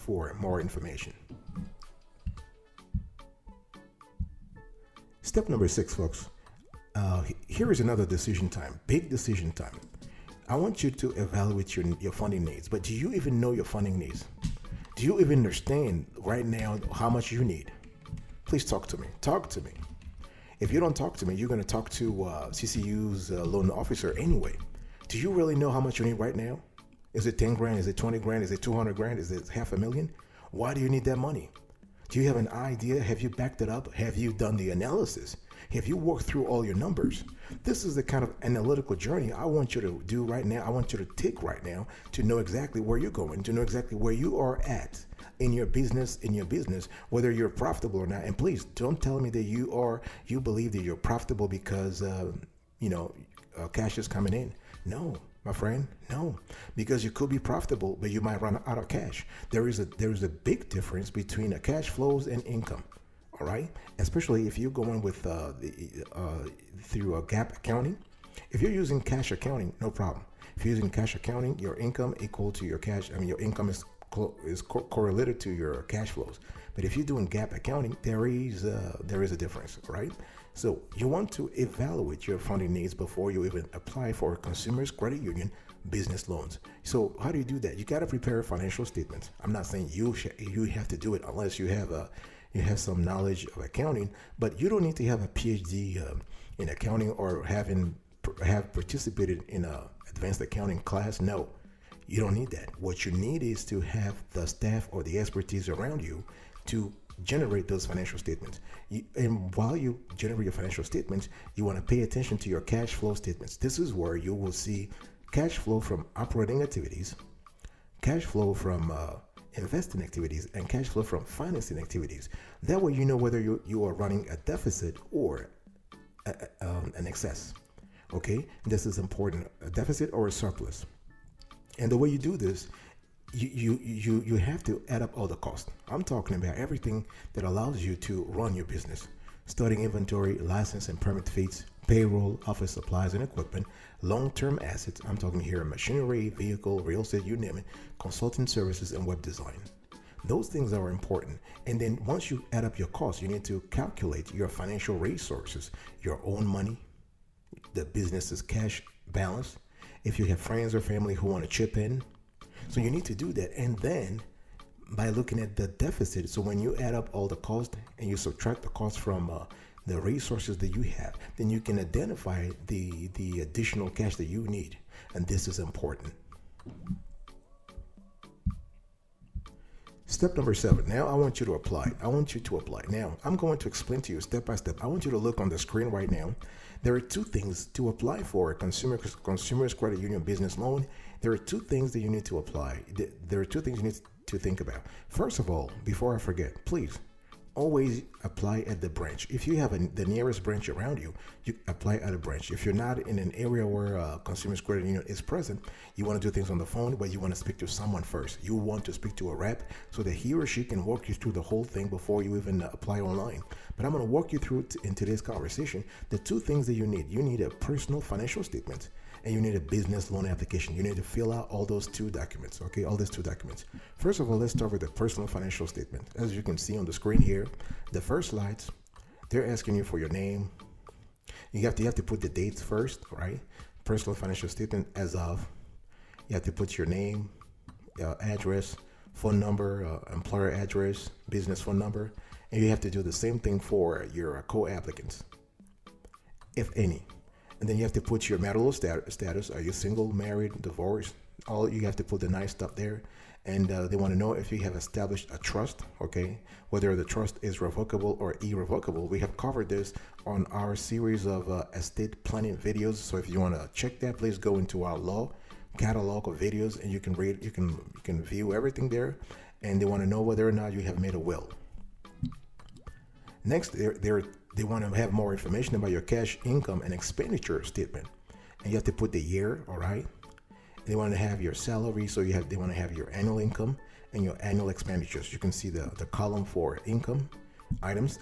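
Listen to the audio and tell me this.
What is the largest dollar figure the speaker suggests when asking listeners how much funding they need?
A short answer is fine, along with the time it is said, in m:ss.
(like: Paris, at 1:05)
half a million, at 0:29.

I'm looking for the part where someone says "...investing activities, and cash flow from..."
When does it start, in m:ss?
1:59.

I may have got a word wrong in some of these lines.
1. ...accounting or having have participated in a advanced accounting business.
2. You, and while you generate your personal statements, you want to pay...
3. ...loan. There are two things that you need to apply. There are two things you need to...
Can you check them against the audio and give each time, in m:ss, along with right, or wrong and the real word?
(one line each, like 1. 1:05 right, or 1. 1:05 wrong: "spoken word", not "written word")
1. 1:36 wrong: "class", not "business"
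2. 1:48 wrong: "financial", not "personal"
3. 3:10 right.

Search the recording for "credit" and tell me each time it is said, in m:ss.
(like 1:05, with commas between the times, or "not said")
1:24, 3:09, 3:24.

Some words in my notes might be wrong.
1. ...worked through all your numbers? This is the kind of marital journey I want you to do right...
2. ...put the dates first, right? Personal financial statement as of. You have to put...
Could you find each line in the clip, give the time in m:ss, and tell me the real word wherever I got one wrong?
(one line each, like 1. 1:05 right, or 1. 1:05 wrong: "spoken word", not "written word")
1. 0:35 wrong: "analytical", not "marital"
2. 3:52 right.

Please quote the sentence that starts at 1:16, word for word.
But if you're doing GAAP accounting, there is there is a difference, right?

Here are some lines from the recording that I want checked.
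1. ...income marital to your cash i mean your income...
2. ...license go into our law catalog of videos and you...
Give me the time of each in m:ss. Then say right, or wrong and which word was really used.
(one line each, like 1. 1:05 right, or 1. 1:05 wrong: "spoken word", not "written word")
1. 1:11 wrong: "equal", not "marital"
2. 4:24 wrong: "please", not "license".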